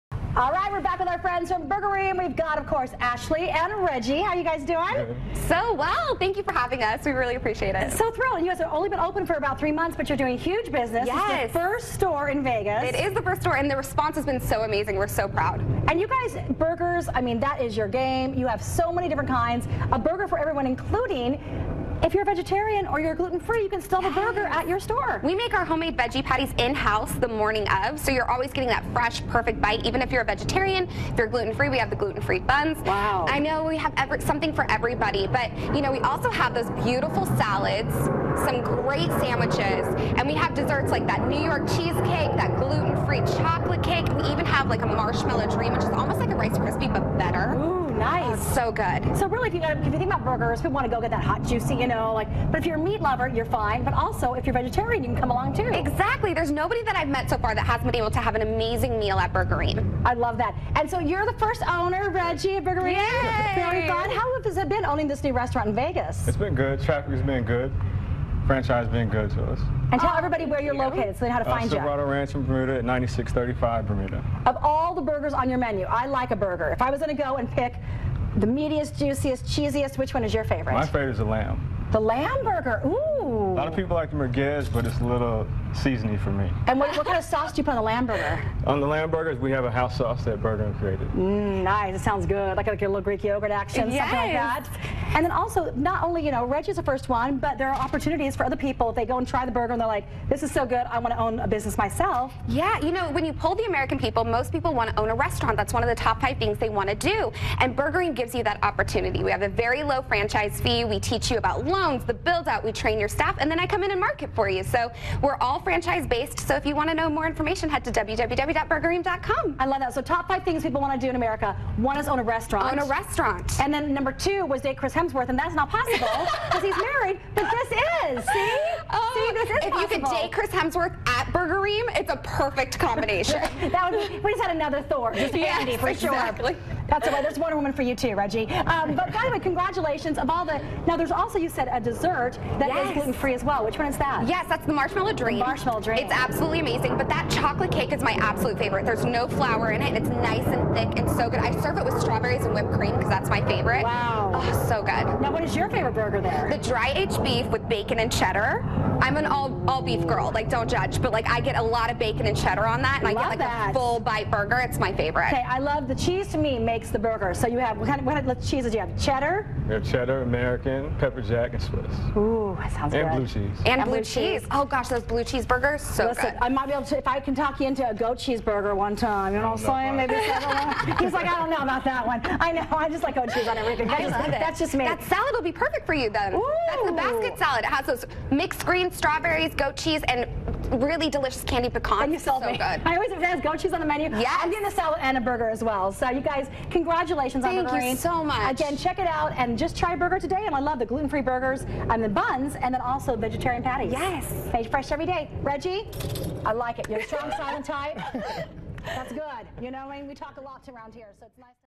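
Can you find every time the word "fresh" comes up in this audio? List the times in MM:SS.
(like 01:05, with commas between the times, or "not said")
00:28, 03:24.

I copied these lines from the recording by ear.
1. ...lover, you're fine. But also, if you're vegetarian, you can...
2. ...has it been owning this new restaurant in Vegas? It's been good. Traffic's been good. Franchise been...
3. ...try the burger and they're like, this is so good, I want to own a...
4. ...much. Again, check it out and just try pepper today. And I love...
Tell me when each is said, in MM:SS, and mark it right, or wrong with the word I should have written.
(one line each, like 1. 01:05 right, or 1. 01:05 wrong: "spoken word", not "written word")
1. 00:53 right
2. 01:04 right
3. 01:39 right
4. 03:18 wrong: "burger", not "pepper".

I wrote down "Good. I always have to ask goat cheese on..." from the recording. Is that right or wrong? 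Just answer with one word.
right.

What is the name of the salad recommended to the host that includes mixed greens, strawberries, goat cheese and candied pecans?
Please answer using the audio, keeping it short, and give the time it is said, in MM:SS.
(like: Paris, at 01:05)
Basket salad, at 03:06.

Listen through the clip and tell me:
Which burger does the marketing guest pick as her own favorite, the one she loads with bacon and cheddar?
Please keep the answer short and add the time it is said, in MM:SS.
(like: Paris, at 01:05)
Dry aged beef, at 02:36.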